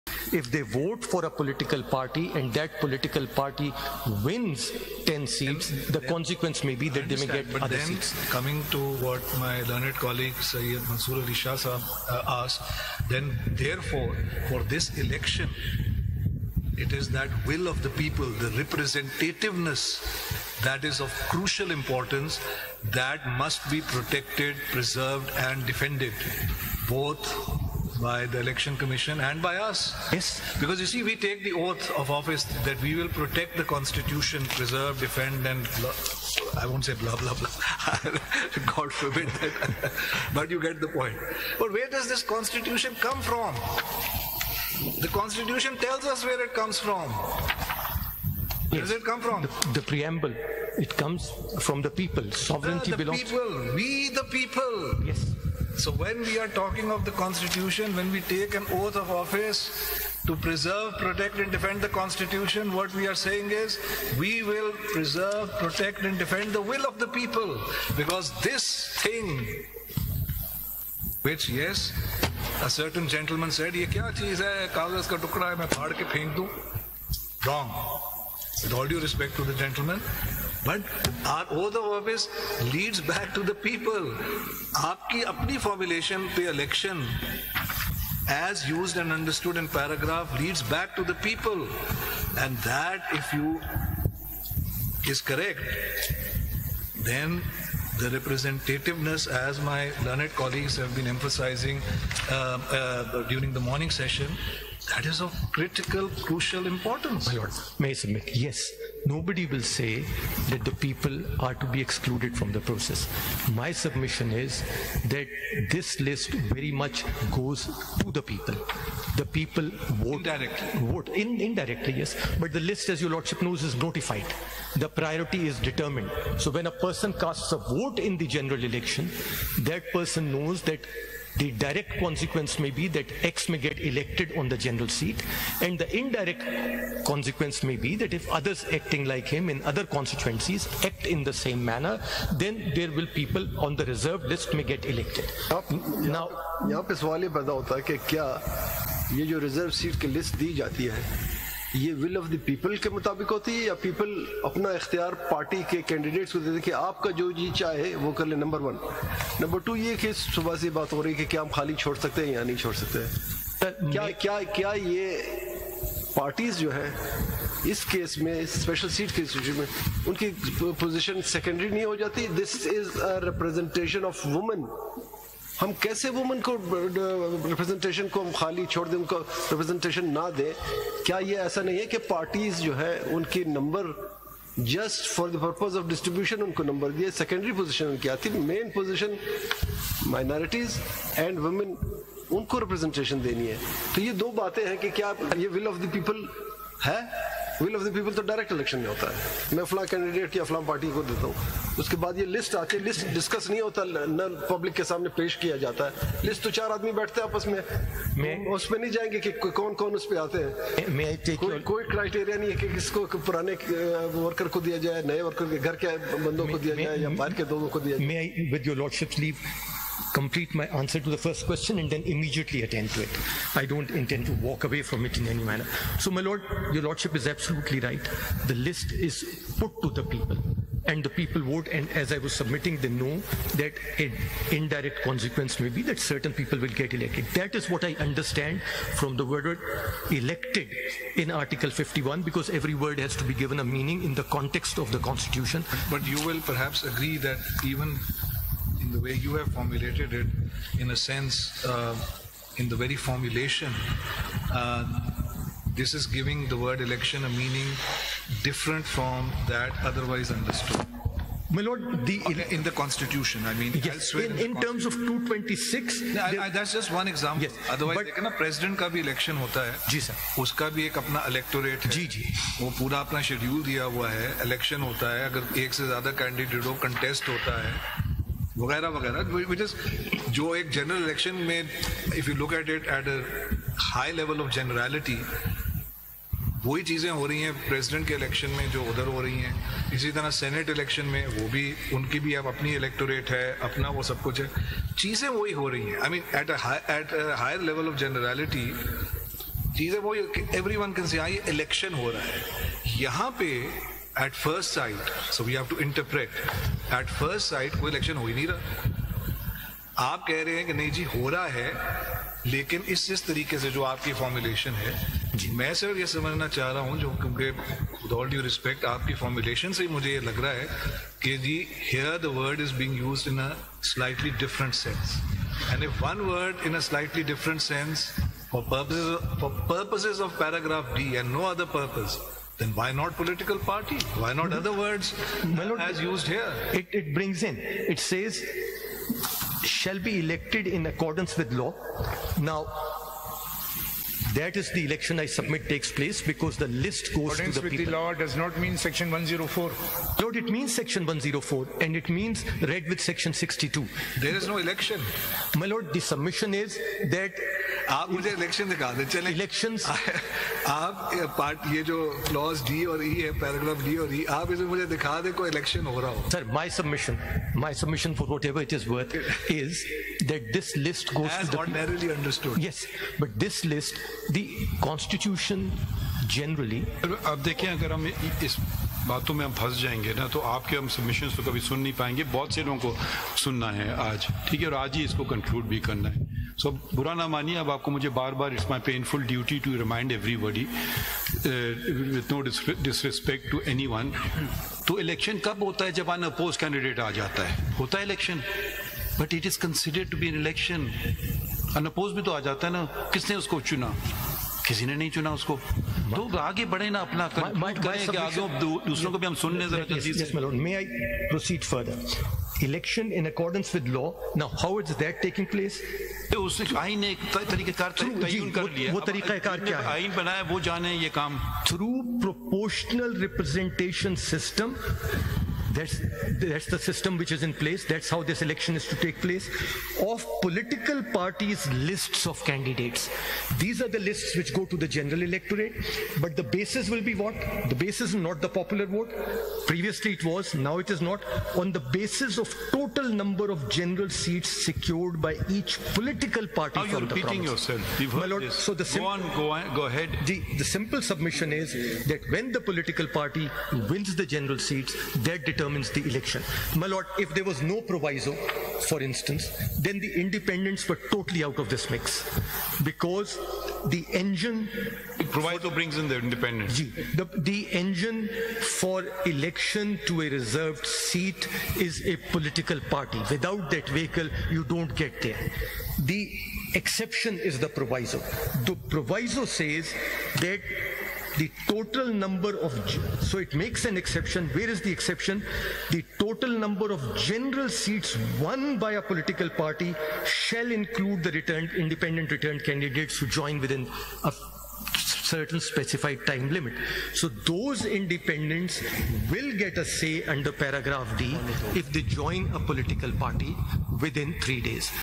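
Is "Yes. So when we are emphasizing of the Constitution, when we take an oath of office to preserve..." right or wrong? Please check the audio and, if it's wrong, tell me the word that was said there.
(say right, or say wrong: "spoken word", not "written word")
wrong: "talking", not "emphasizing".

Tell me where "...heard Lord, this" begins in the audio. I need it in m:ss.
7:28.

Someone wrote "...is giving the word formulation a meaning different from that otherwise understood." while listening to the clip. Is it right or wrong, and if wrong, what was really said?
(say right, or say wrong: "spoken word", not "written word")
wrong: "election", not "formulation".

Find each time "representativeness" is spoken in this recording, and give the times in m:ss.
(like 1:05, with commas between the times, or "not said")
0:18, 1:38.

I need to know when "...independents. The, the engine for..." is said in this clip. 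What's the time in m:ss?
7:46.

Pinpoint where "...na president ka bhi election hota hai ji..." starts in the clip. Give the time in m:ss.
4:28.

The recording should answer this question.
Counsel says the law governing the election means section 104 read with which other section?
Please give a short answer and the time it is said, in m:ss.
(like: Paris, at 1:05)
Section 62, at 5:53.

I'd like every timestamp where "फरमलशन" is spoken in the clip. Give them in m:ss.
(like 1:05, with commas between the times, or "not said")
5:14, 5:19.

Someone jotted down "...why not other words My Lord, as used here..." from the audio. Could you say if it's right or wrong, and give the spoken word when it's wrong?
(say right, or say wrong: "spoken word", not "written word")
right.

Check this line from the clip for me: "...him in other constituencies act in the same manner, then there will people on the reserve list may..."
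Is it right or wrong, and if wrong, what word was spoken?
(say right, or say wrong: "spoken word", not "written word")
right.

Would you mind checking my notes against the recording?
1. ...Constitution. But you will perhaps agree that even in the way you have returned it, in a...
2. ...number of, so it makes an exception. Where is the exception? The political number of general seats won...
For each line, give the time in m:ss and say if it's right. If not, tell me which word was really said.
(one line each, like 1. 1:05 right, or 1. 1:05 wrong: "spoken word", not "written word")
1. 4:04 wrong: "formulated", not "returned"
2. 8:02 wrong: "total", not "political".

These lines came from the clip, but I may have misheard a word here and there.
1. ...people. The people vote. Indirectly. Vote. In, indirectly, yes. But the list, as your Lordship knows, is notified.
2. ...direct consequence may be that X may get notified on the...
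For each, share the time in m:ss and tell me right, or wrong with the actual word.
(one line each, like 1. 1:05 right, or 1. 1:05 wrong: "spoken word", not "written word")
1. 1:58 right
2. 2:11 wrong: "elected", not "notified".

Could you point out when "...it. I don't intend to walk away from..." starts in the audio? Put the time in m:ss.
3:43.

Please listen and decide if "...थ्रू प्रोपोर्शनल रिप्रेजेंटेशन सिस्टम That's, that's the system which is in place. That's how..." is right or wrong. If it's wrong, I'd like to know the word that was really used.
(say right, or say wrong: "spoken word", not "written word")
right.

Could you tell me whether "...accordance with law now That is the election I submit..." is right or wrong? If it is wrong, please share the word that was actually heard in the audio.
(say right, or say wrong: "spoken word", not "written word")
right.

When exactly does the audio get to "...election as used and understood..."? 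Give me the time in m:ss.
1:26.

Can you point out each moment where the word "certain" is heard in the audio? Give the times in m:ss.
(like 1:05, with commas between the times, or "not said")
1:12, 3:55, 8:14.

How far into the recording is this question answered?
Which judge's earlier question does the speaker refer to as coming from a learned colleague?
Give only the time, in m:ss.
0:10.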